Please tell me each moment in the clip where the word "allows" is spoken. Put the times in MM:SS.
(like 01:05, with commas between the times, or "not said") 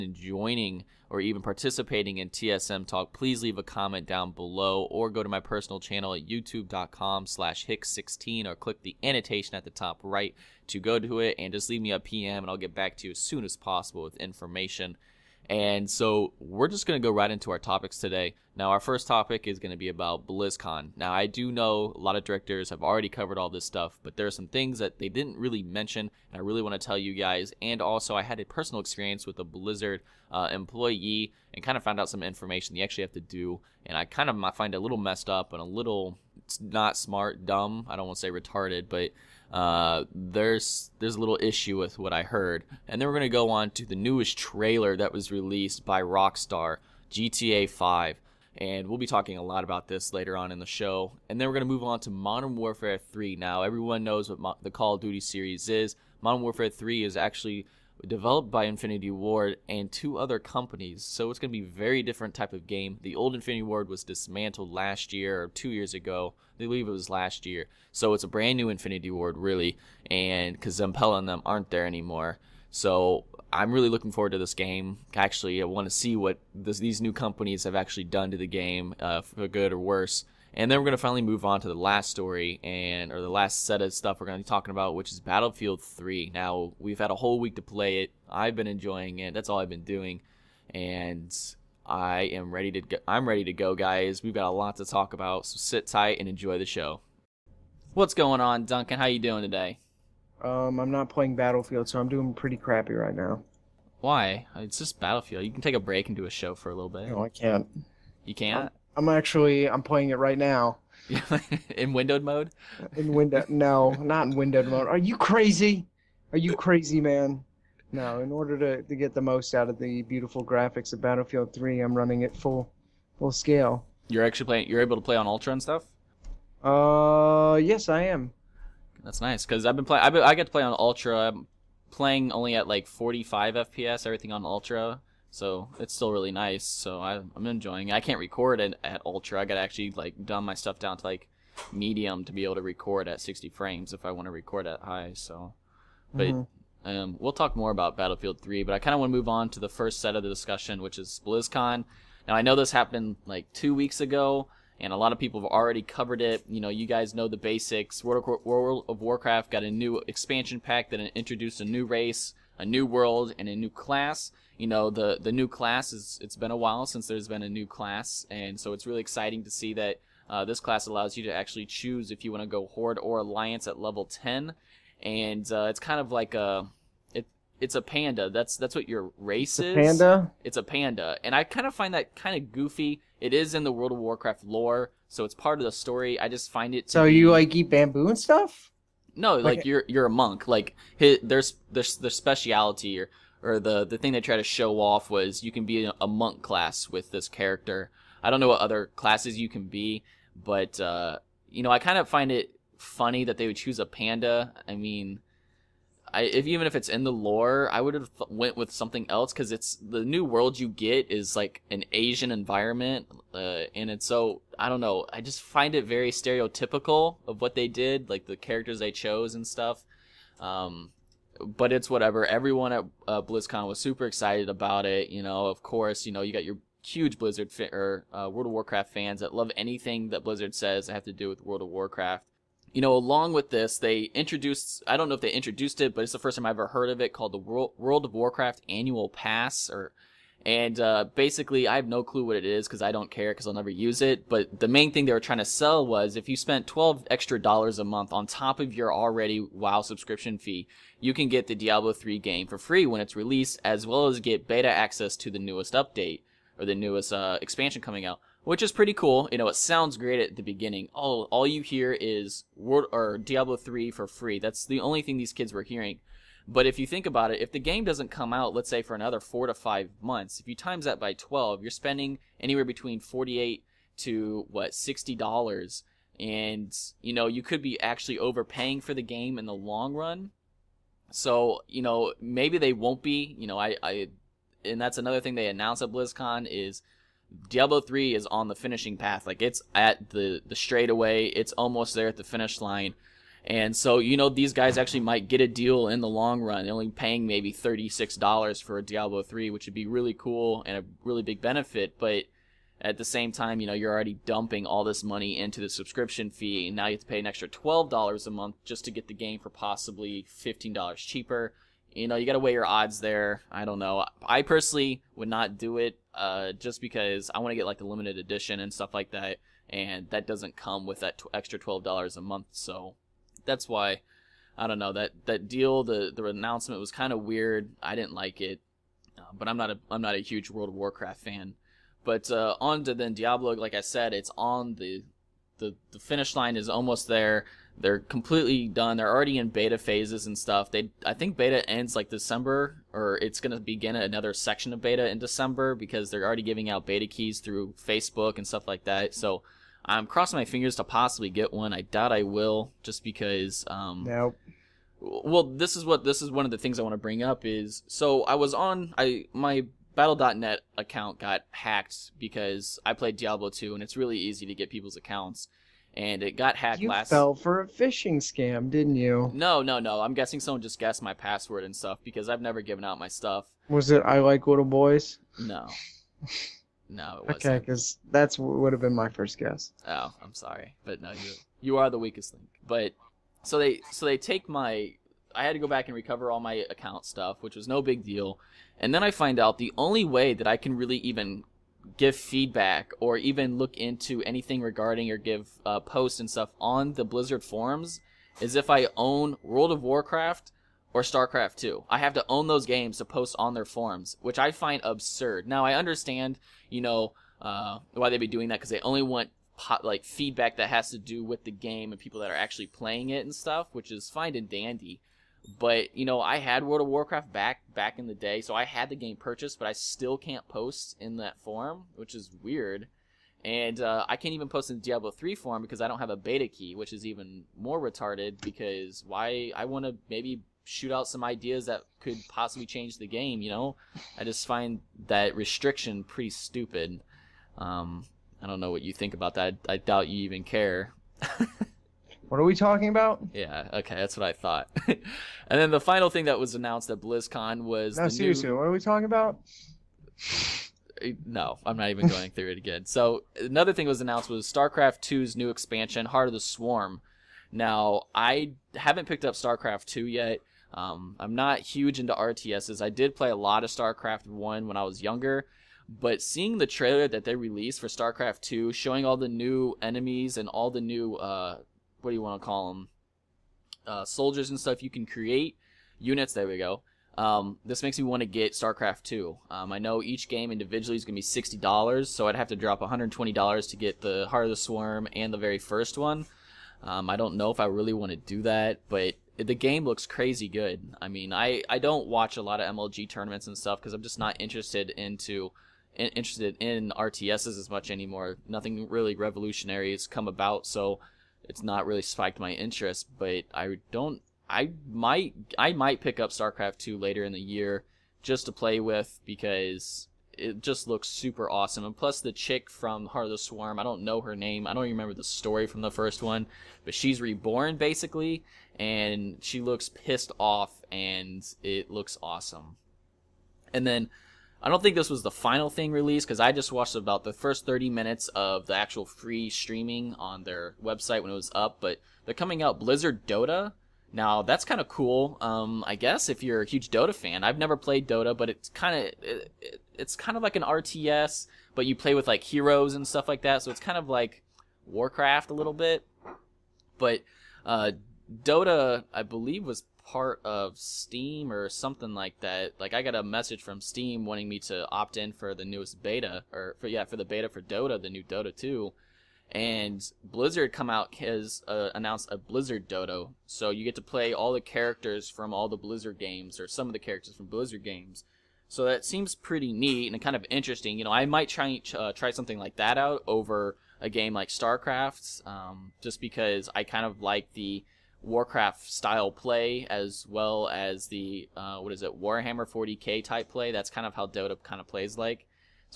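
02:50.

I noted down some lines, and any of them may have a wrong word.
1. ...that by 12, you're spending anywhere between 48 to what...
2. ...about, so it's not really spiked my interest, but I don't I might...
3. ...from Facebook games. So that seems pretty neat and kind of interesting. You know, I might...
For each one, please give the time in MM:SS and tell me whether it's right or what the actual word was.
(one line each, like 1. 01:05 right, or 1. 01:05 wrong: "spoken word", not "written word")
1. 04:30 right
2. 08:20 right
3. 09:27 wrong: "Blizzard", not "Facebook".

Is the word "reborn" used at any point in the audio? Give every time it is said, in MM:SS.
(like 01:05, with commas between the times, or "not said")
08:37.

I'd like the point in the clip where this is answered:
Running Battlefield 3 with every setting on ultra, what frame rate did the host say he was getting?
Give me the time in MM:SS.
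02:12.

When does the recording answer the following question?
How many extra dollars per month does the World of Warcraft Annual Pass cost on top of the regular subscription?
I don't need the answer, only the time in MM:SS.
04:06.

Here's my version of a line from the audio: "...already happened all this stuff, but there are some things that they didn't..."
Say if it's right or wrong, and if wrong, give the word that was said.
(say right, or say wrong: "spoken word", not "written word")
wrong: "covered", not "happened".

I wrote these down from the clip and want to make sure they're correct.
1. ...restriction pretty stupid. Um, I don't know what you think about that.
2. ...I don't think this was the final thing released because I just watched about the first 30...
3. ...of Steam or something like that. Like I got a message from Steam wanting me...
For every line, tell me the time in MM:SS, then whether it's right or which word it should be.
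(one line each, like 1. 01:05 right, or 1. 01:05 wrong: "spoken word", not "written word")
1. 07:15 right
2. 08:44 right
3. 09:10 right.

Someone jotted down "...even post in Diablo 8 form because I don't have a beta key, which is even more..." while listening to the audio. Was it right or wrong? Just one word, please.
wrong.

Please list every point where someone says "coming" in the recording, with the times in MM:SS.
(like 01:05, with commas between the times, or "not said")
04:17, 08:52.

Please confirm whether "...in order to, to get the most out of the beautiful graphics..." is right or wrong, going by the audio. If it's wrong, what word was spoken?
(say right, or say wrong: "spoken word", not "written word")
right.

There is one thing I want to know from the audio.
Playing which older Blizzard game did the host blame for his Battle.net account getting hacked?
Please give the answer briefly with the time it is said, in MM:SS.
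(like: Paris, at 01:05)
Diablo 2, at 06:03.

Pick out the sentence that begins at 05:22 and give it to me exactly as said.
So that's why I don't know that that deal.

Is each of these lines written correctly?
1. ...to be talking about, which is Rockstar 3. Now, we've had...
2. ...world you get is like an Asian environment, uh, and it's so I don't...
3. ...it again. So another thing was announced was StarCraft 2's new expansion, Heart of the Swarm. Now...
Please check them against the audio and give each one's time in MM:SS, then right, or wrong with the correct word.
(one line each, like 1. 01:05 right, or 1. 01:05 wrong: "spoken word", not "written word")
1. 01:24 wrong: "Battlefield", not "Rockstar"
2. 03:30 right
3. 07:32 right.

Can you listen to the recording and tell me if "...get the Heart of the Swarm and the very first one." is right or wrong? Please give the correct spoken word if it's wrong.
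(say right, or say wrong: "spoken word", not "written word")
right.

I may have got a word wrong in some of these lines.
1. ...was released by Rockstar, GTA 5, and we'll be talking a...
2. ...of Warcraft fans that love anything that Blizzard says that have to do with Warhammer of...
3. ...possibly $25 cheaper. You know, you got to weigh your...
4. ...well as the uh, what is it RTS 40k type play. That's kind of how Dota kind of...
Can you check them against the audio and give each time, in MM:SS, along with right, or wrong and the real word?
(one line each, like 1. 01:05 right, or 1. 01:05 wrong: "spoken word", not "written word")
1. 00:45 right
2. 03:48 wrong: "World", not "Warhammer"
3. 05:09 wrong: "15", not "25"
4. 09:40 wrong: "Warhammer", not "RTS".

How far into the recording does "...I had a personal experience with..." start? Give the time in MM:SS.
00:28.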